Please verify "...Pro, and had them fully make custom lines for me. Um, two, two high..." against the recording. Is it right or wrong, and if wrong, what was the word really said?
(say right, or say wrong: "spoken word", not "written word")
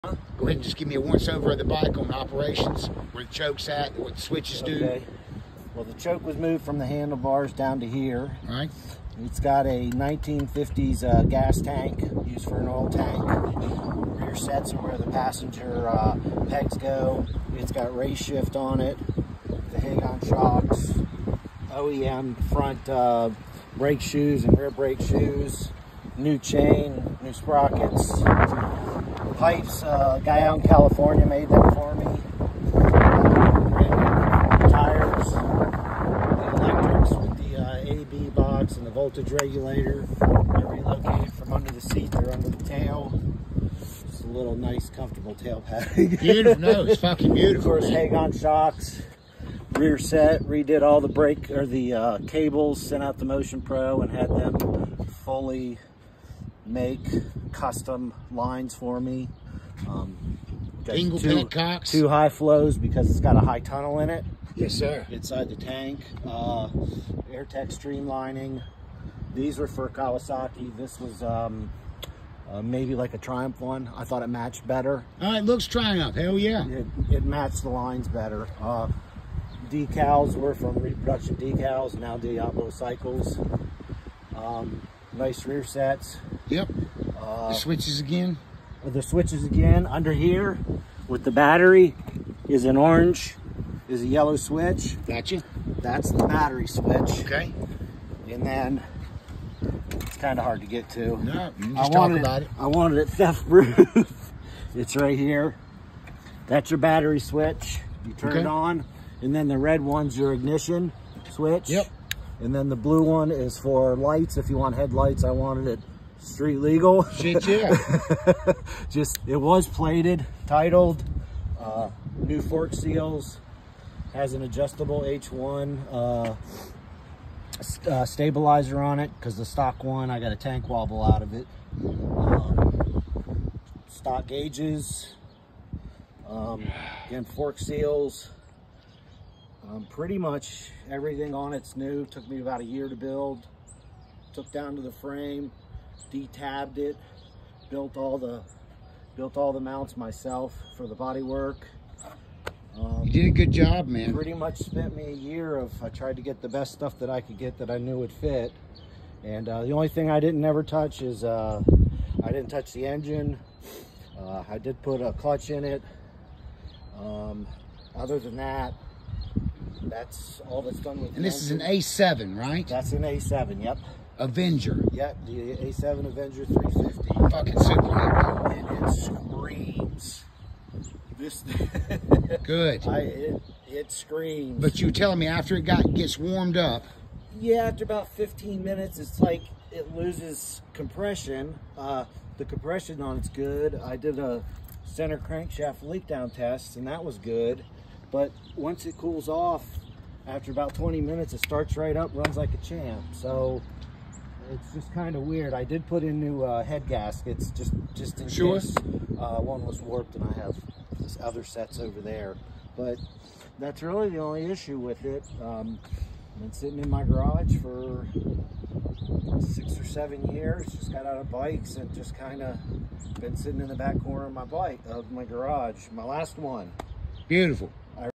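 right.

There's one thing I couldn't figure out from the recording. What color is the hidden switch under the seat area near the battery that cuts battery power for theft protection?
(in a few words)
Yellow.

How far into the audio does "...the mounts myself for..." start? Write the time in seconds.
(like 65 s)
149 s.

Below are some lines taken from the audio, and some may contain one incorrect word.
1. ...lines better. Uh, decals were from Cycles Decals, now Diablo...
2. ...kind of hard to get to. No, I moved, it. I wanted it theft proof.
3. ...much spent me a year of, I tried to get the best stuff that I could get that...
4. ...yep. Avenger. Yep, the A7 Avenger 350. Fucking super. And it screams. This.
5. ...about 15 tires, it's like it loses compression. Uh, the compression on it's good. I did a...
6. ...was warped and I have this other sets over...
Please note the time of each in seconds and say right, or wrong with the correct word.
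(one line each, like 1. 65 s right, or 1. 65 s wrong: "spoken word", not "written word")
1. 77 s wrong: "Reproduction", not "Cycles"
2. 100 s wrong: "wanted", not "moved"
3. 154 s right
4. 173 s right
5. 187 s wrong: "minutes", not "tires"
6. 209 s right.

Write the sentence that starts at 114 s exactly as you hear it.
If you want headlights, I wanted it street legal.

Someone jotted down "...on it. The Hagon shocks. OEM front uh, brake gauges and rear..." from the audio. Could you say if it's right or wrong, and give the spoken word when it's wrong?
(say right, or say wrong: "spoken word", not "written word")
wrong: "shoes", not "gauges".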